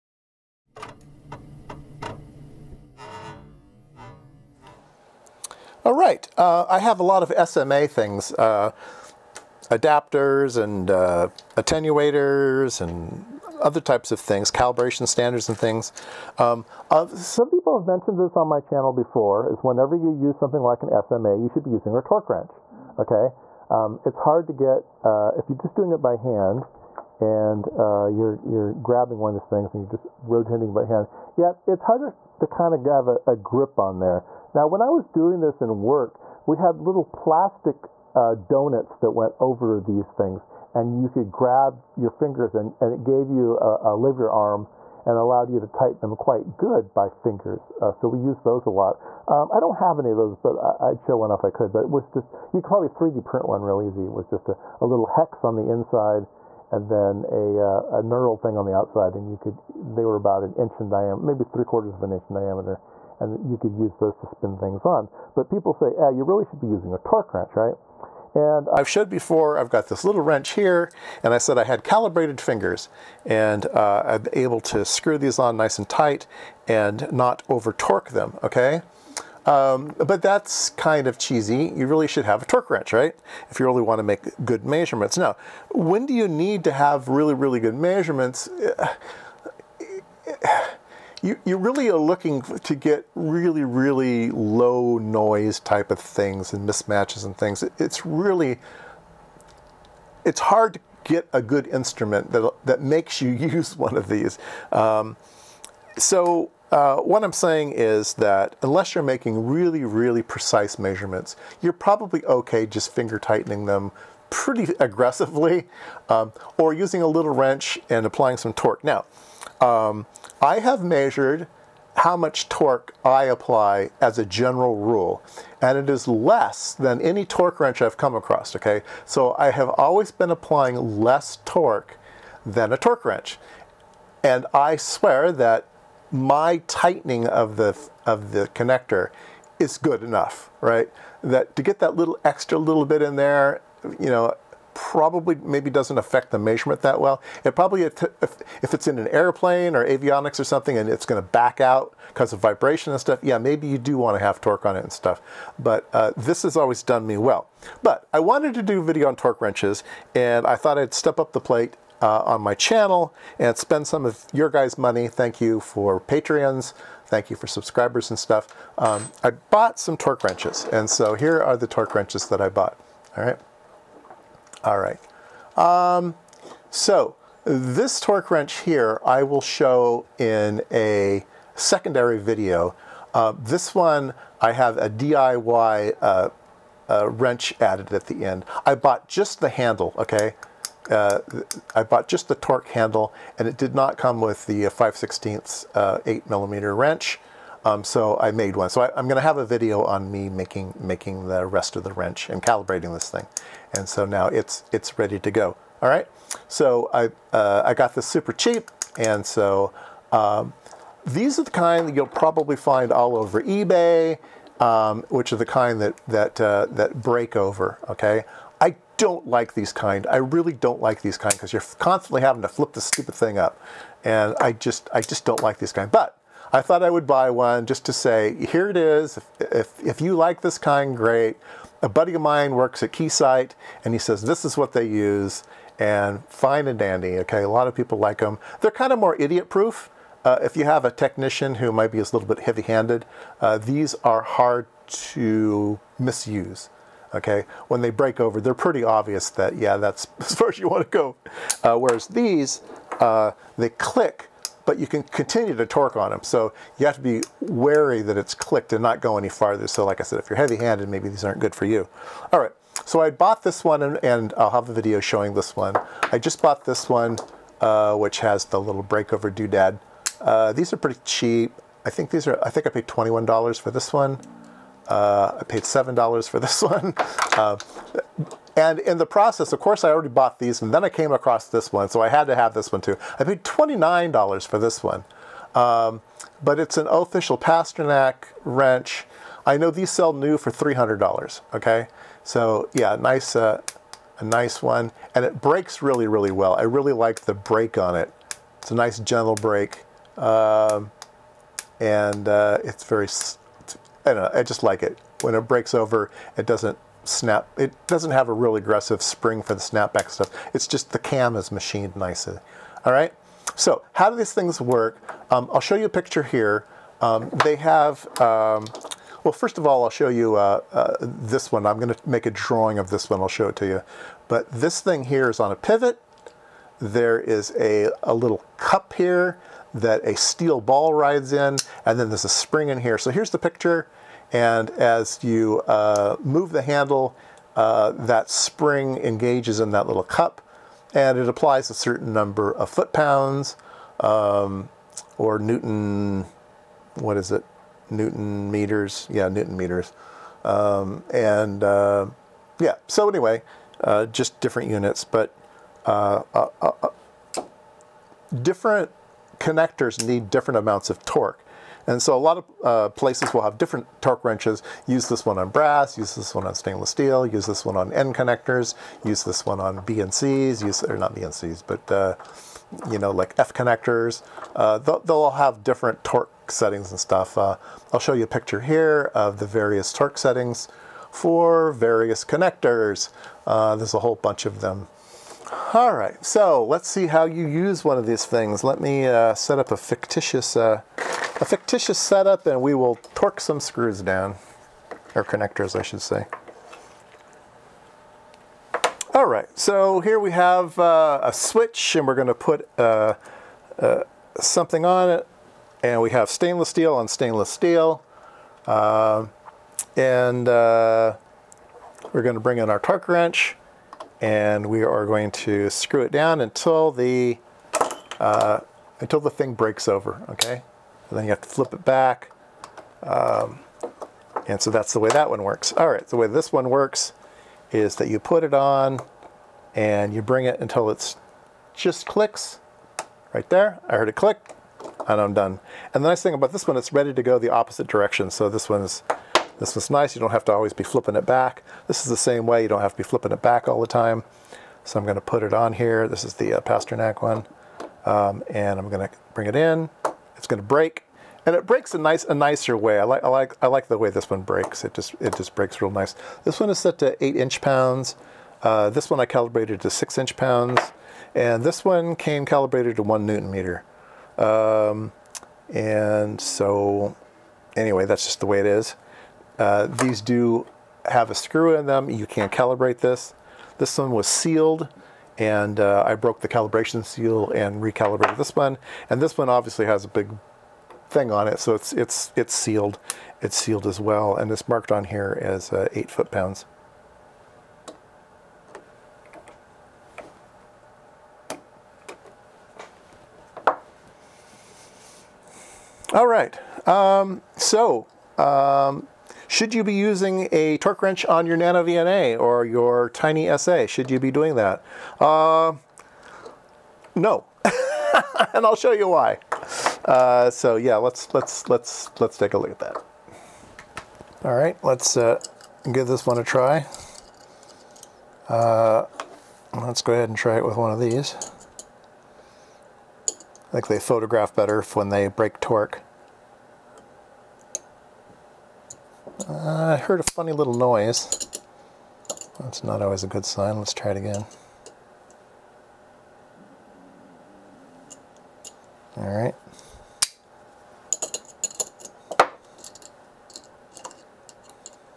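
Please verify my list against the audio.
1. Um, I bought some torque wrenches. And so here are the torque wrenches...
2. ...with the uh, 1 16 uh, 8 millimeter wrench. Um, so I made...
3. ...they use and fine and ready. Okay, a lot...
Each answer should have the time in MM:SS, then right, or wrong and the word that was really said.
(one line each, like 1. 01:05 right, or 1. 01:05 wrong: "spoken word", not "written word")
1. 02:48 right
2. 03:14 wrong: "5", not "1"
3. 03:54 wrong: "dandy", not "ready".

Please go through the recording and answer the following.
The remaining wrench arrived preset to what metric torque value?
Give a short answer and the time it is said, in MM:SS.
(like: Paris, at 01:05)
1 Newton meter, at 07:43.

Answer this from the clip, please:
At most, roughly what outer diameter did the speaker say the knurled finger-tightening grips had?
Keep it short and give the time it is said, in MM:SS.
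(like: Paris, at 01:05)
about an inch, at 01:00.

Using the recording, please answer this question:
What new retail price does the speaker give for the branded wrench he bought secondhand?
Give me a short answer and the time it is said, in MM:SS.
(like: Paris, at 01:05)
$300, at 04:50.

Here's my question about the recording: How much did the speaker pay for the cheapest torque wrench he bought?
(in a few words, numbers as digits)
$7.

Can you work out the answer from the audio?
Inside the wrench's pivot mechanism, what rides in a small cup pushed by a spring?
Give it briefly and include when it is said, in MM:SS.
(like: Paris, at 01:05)
a steel ball, at 05:30.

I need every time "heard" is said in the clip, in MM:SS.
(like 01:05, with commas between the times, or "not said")
07:13, 08:49.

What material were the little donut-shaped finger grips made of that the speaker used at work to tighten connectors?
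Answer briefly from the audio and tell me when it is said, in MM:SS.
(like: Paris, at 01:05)
plastic, at 00:37.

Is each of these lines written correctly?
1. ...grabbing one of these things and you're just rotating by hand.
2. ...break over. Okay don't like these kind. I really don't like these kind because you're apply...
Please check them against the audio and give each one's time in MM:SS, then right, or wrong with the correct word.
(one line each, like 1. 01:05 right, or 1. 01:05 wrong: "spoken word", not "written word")
1. 00:28 right
2. 03:37 wrong: "constantly", not "apply".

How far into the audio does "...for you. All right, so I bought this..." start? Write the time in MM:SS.
04:21.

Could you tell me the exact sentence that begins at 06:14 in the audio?
Uh, they'll, they'll, all have different torque settings and stuff.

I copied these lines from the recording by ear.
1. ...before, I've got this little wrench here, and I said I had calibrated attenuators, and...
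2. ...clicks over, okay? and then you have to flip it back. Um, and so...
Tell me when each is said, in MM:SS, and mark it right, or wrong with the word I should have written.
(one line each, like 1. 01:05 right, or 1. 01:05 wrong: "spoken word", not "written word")
1. 01:09 wrong: "fingers", not "attenuators"
2. 06:59 wrong: "breaks", not "clicks".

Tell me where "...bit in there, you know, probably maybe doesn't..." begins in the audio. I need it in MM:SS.
02:22.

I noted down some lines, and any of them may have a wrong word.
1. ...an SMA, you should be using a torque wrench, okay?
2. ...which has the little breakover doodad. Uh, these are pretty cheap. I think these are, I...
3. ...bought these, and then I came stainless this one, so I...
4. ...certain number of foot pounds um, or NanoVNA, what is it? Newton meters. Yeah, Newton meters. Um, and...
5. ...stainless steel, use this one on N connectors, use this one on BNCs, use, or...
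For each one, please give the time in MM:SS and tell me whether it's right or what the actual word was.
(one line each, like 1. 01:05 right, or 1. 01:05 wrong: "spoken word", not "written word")
1. 00:20 right
2. 04:27 right
3. 04:40 wrong: "across", not "stainless"
4. 05:41 wrong: "Newton", not "NanoVNA"
5. 06:06 right.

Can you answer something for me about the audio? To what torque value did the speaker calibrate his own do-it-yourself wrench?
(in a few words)
6 inch pounds.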